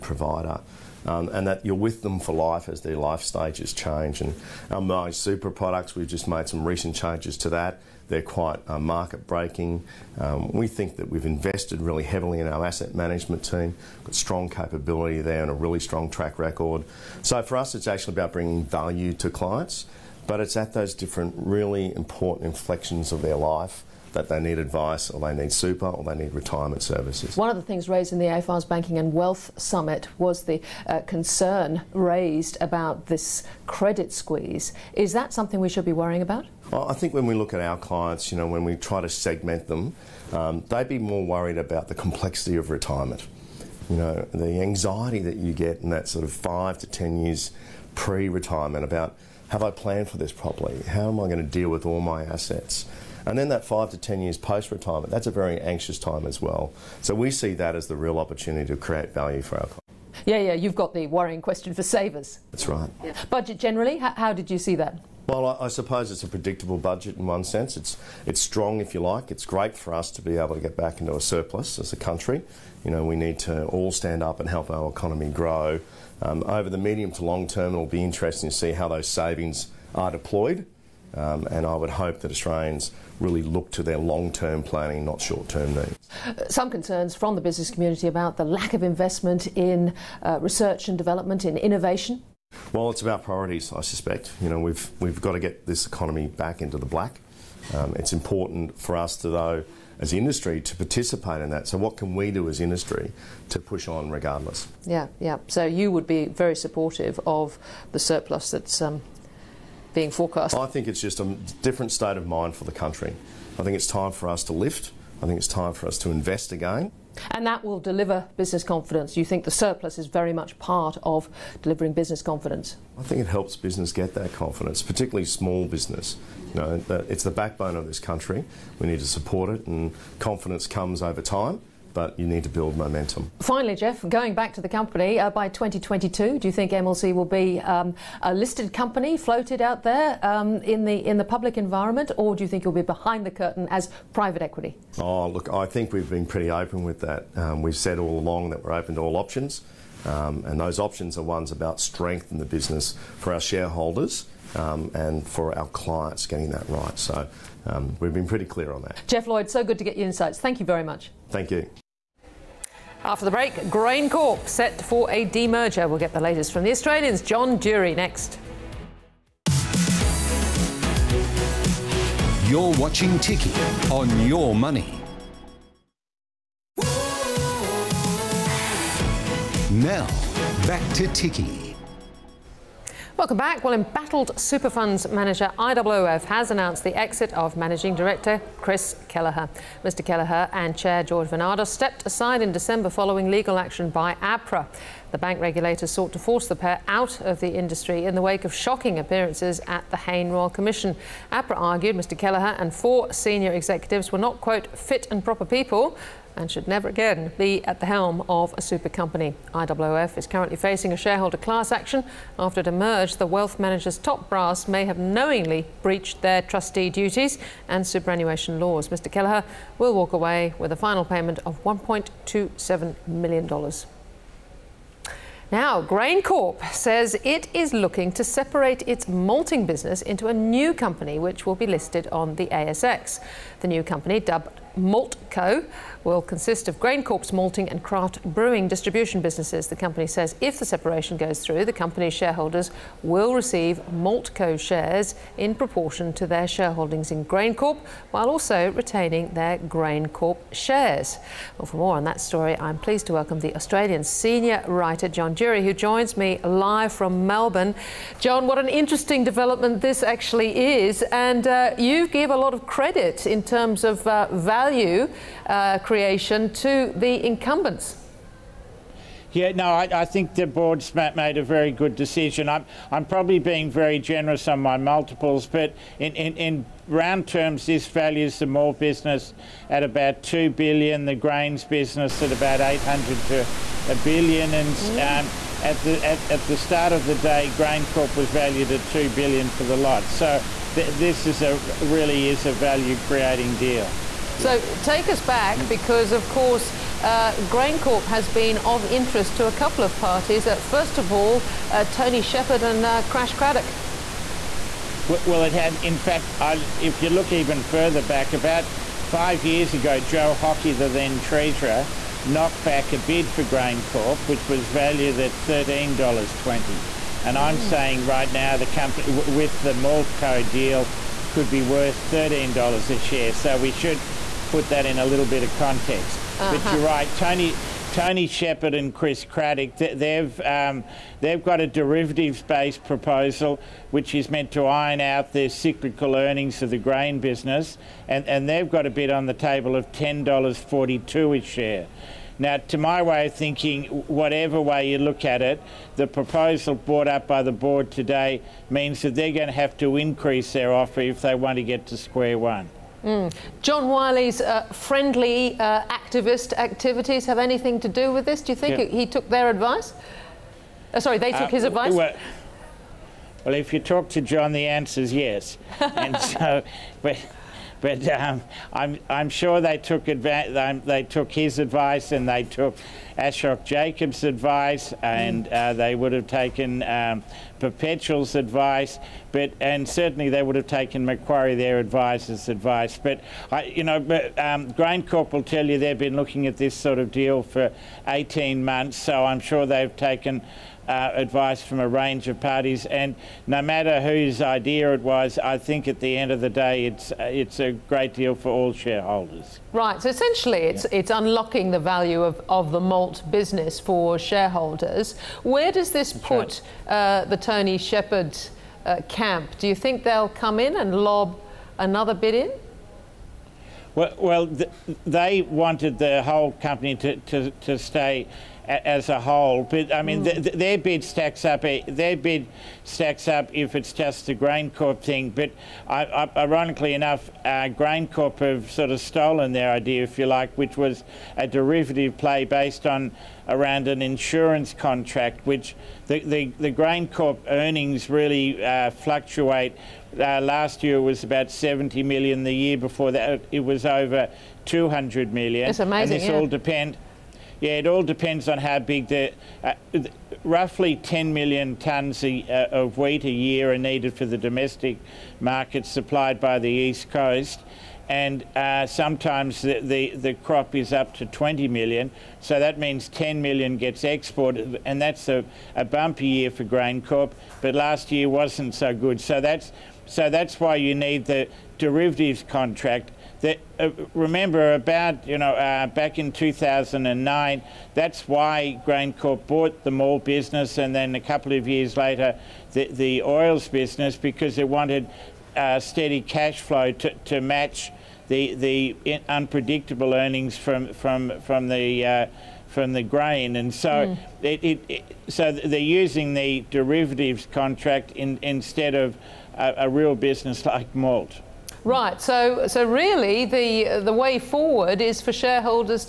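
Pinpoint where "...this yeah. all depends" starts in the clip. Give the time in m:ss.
7:26.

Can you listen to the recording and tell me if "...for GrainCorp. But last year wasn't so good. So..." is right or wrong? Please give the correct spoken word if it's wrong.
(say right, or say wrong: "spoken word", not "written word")
right.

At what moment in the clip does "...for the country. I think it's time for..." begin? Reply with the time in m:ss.
1:52.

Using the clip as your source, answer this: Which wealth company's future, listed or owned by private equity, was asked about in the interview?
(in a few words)
MLC.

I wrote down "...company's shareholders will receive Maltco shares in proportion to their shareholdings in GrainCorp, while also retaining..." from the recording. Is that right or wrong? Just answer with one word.
right.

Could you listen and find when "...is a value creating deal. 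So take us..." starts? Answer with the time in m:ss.
4:52.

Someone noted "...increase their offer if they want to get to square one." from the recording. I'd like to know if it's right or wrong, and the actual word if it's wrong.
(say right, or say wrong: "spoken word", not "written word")
right.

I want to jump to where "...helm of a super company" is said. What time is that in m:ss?
3:27.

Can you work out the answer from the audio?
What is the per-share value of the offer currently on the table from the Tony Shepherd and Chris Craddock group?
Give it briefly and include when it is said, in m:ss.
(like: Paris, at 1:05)
$10.42, at 5:39.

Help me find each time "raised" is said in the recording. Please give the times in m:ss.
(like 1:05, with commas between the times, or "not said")
0:27, 0:31.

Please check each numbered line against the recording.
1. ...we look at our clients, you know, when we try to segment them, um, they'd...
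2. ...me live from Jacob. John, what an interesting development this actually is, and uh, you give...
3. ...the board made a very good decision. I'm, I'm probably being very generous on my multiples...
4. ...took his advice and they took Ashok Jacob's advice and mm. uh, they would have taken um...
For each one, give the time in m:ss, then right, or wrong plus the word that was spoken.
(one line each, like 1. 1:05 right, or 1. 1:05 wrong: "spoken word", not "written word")
1. 0:37 right
2. 4:16 wrong: "Melbourne", not "Jacob"
3. 4:30 right
4. 6:11 right.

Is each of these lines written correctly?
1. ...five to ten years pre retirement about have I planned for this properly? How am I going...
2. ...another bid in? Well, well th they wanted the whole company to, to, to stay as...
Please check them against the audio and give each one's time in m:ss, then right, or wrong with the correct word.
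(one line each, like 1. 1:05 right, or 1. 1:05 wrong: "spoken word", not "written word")
1. 0:46 right
2. 6:51 right.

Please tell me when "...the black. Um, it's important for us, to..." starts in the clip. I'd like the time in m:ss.
1:36.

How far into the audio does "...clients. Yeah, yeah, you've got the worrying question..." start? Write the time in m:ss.
0:59.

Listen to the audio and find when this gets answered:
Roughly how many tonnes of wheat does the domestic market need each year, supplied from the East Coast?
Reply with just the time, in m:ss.
7:30.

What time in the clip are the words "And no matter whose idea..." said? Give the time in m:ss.
6:32.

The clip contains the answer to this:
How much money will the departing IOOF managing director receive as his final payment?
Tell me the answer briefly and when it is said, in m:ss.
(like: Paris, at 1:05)
$1.27 million, at 3:41.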